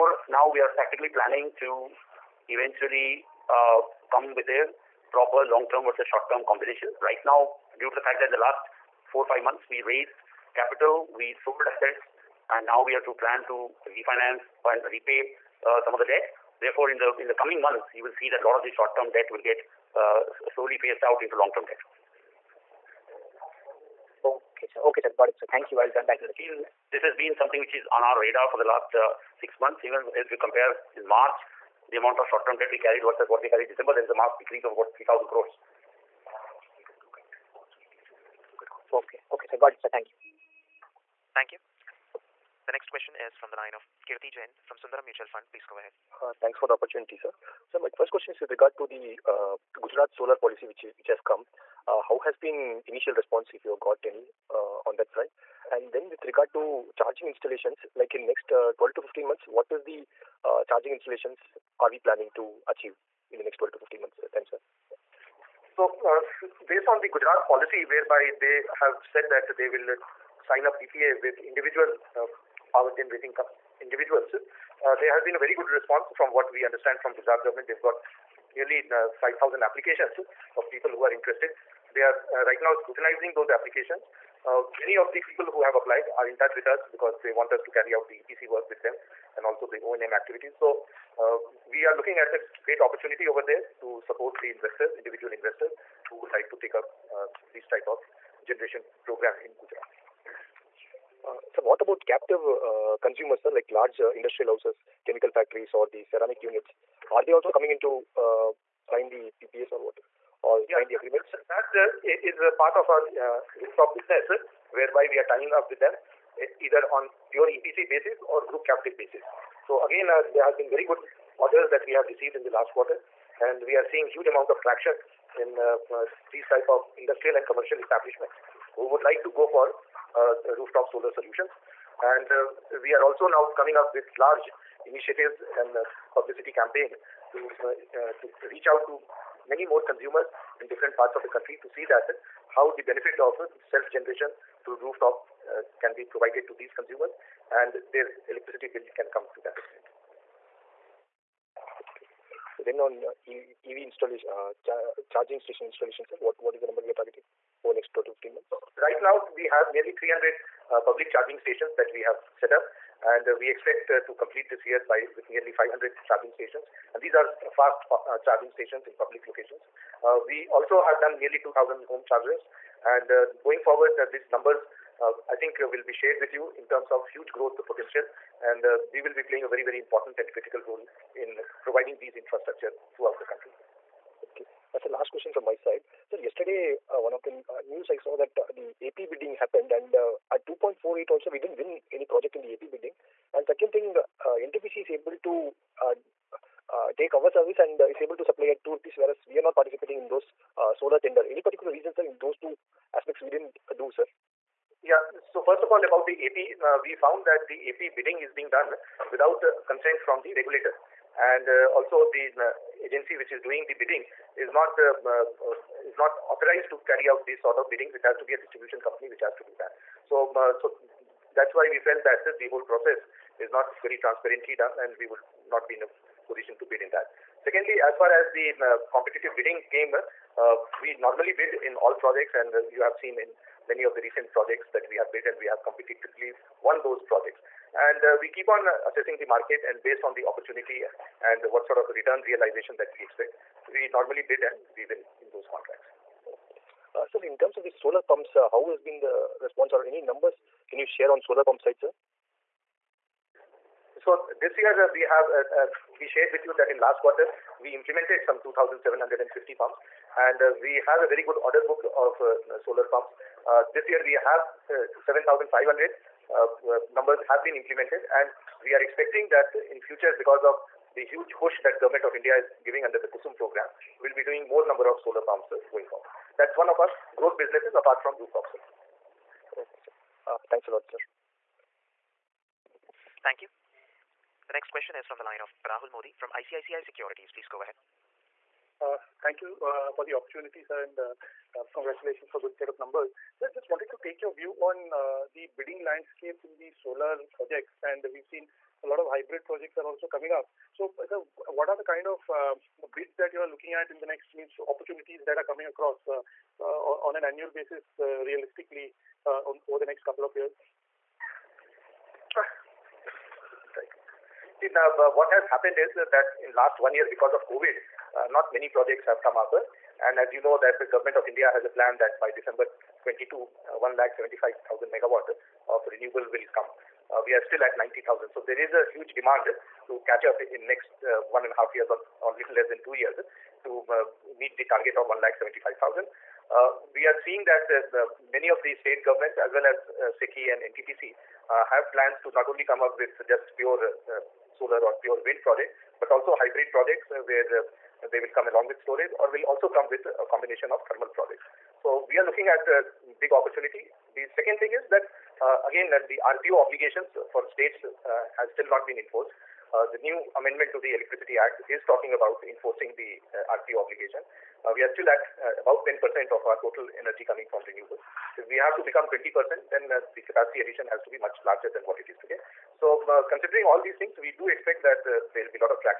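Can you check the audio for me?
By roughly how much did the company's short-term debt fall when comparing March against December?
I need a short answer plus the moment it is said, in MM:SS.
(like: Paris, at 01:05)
3,000 crores, at 00:34.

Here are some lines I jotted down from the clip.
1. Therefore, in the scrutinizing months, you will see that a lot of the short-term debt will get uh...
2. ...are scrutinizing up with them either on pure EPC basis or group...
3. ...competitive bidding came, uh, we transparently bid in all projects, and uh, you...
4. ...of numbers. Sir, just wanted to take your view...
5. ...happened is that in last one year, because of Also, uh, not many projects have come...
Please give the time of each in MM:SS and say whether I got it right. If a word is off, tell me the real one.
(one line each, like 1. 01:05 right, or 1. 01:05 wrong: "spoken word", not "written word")
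1. 00:16 wrong: "coming", not "scrutinizing"
2. 01:55 wrong: "tying", not "scrutinizing"
3. 03:48 wrong: "normally", not "transparently"
4. 04:52 right
5. 05:15 wrong: "COVID", not "Also".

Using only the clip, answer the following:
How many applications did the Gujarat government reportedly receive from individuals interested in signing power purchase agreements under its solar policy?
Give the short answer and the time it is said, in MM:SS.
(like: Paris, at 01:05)
5,000, at 01:19.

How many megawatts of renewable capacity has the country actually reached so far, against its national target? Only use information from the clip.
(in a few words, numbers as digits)
90,000.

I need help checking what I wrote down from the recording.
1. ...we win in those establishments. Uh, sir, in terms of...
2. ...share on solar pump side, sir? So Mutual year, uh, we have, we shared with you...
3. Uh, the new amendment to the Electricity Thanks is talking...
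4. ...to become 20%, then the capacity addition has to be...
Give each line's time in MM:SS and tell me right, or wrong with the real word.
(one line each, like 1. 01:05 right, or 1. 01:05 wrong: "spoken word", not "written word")
1. 04:04 wrong: "contracts", not "establishments"
2. 04:10 wrong: "This", not "Mutual"
3. 05:59 wrong: "Act", not "Thanks"
4. 06:08 right.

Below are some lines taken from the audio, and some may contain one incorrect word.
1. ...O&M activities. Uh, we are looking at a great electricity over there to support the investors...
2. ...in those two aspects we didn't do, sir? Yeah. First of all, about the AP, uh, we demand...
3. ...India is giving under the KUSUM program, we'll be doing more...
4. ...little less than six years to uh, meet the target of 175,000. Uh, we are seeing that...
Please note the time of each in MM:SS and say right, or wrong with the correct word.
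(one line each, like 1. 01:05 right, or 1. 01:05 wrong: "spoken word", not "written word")
1. 01:29 wrong: "opportunity", not "electricity"
2. 03:22 wrong: "found", not "demand"
3. 04:32 right
4. 05:32 wrong: "two", not "six".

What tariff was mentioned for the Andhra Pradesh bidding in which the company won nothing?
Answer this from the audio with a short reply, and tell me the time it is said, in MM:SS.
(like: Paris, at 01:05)
2.48, at 03:10.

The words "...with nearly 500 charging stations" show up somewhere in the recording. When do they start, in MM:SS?
02:45.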